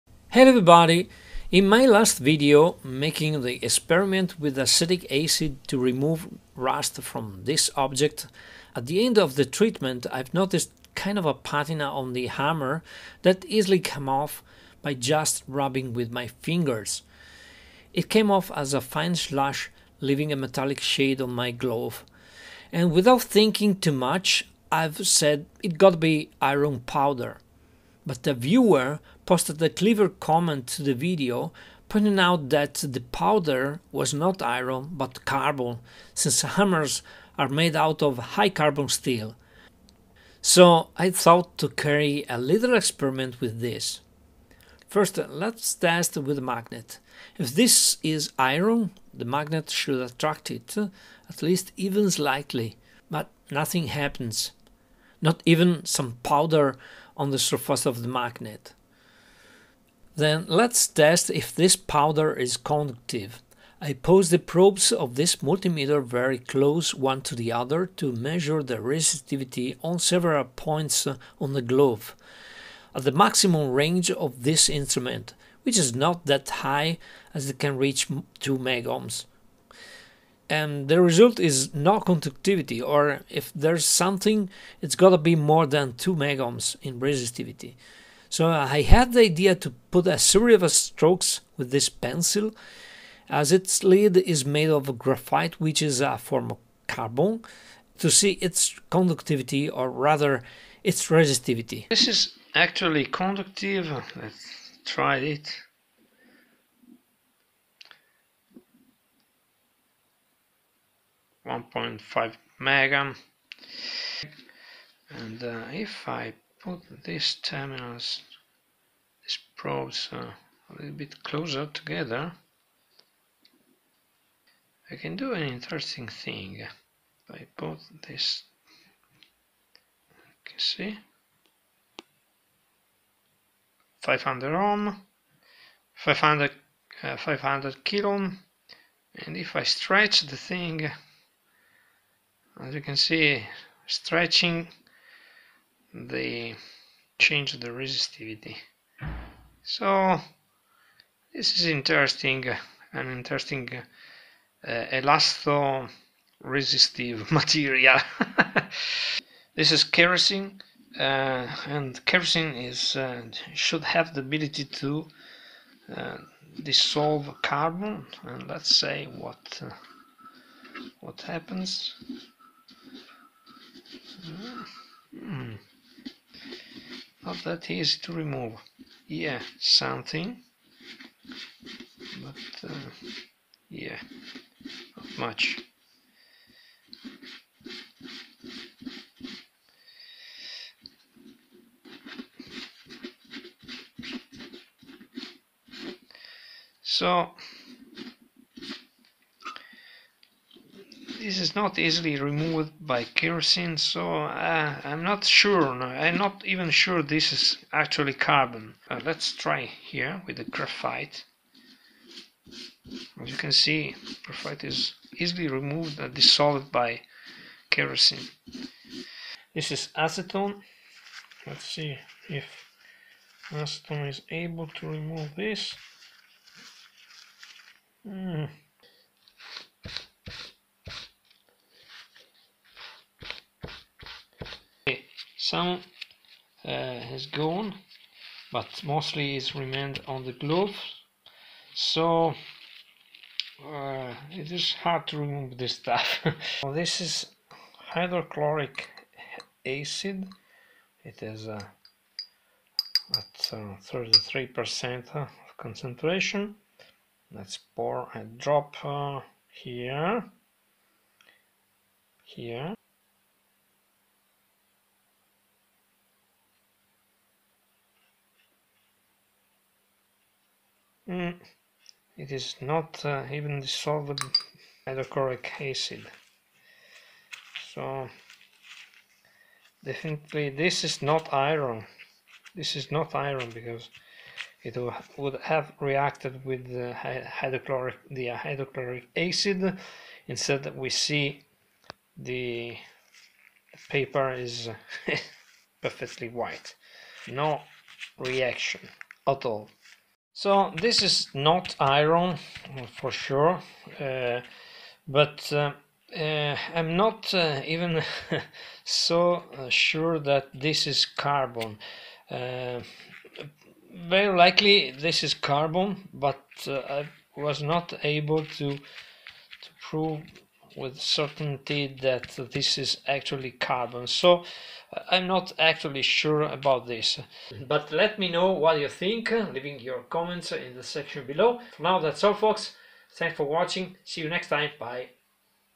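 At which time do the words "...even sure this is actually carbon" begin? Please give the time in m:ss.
3:26.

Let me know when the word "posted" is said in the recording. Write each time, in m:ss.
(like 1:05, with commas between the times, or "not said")
0:29.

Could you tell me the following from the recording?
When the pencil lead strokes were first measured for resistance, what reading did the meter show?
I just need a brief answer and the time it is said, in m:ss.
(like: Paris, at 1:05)
1.5 megohms, at 1:51.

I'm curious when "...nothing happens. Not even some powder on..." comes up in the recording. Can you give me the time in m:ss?
0:53.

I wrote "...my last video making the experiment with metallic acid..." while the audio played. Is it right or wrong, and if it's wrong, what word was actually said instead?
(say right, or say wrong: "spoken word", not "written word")
wrong: "acetic", not "metallic".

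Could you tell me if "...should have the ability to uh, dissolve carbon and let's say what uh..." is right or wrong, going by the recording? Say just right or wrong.
right.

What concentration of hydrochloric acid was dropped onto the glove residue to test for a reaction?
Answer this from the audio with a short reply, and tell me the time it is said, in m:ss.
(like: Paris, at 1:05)
33%, at 4:13.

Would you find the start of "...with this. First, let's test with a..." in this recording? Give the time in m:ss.
0:43.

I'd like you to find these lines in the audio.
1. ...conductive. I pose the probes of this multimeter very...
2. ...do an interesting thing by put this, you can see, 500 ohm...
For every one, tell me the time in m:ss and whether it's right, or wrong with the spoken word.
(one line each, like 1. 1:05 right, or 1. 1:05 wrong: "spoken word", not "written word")
1. 1:02 right
2. 2:05 right.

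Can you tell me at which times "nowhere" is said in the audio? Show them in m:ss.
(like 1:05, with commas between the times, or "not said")
not said.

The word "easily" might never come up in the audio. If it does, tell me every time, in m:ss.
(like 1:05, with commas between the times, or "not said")
0:13, 3:21, 3:35.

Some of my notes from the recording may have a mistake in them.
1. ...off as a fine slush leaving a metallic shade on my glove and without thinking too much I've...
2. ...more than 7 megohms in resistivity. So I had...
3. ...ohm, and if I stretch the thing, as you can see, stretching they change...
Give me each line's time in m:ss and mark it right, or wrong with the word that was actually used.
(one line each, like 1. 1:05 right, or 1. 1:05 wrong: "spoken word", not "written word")
1. 0:18 right
2. 1:25 wrong: "2", not "7"
3. 2:18 right.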